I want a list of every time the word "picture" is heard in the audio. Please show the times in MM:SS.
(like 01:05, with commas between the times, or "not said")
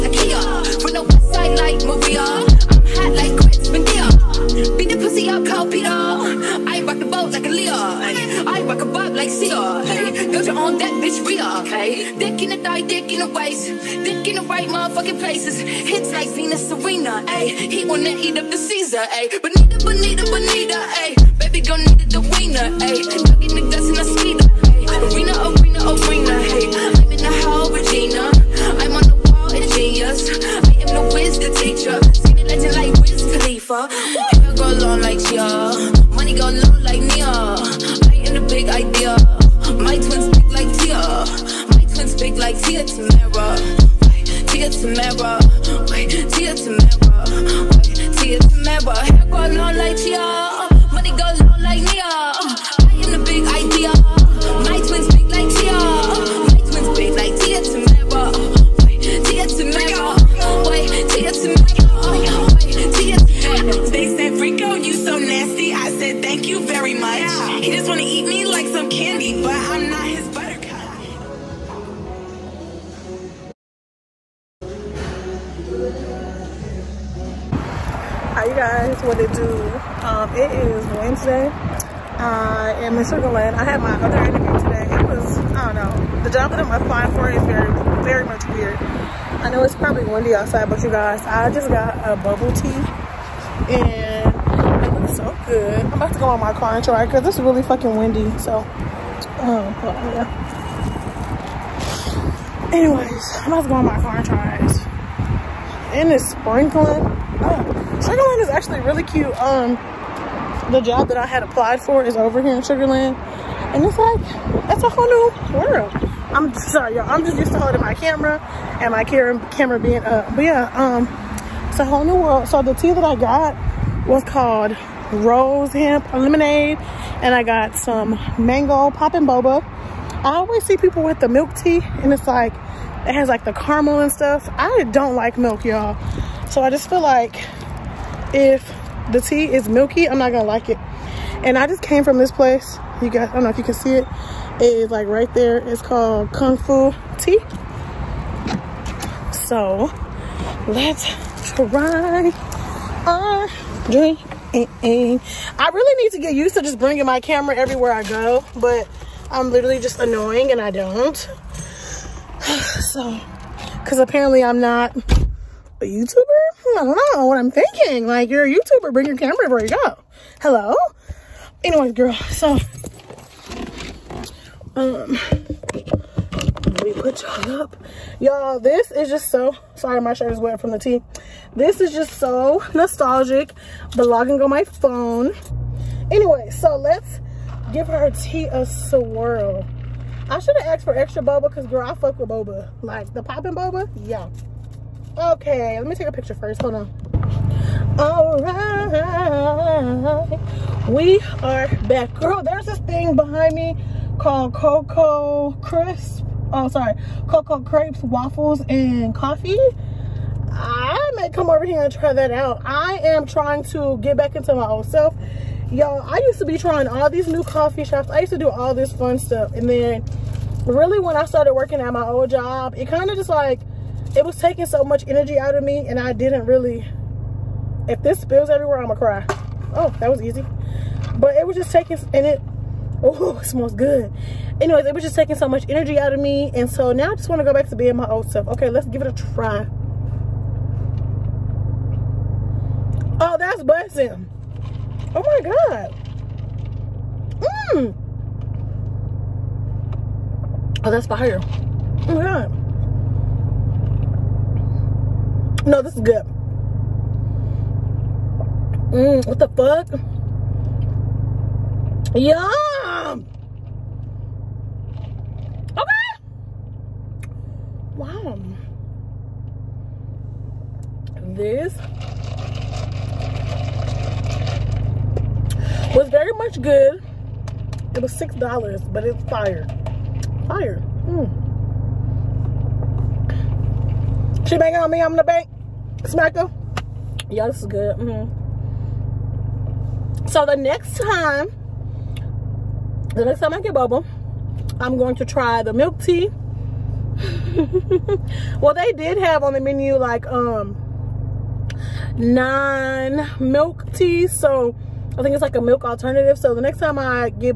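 03:16.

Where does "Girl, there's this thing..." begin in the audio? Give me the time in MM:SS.
03:22.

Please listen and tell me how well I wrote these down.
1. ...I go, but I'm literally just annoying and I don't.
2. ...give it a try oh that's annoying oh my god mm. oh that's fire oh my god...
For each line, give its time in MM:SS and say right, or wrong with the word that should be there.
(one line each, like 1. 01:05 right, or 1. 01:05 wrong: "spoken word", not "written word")
1. 02:37 right
2. 03:58 wrong: "busting", not "annoying".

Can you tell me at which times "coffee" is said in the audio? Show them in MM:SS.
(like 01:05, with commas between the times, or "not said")
03:29, 03:37.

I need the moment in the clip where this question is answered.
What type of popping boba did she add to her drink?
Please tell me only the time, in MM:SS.
02:08.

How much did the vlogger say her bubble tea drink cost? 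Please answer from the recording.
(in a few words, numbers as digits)
$6.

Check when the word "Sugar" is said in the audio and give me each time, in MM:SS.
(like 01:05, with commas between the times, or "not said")
01:48, 01:52.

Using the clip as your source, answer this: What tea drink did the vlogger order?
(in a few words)
Rose hemp lemonade.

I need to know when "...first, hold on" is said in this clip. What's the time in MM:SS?
03:16.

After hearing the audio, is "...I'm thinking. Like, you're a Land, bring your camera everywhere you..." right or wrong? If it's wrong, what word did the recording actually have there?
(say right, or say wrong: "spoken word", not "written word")
wrong: "YouTuber", not "Land".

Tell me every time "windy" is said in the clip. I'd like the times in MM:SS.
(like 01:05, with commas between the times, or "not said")
01:30, 01:37.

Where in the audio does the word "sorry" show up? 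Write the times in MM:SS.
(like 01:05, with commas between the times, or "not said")
01:56, 02:59, 03:26.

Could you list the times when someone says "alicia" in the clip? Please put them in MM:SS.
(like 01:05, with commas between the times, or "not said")
not said.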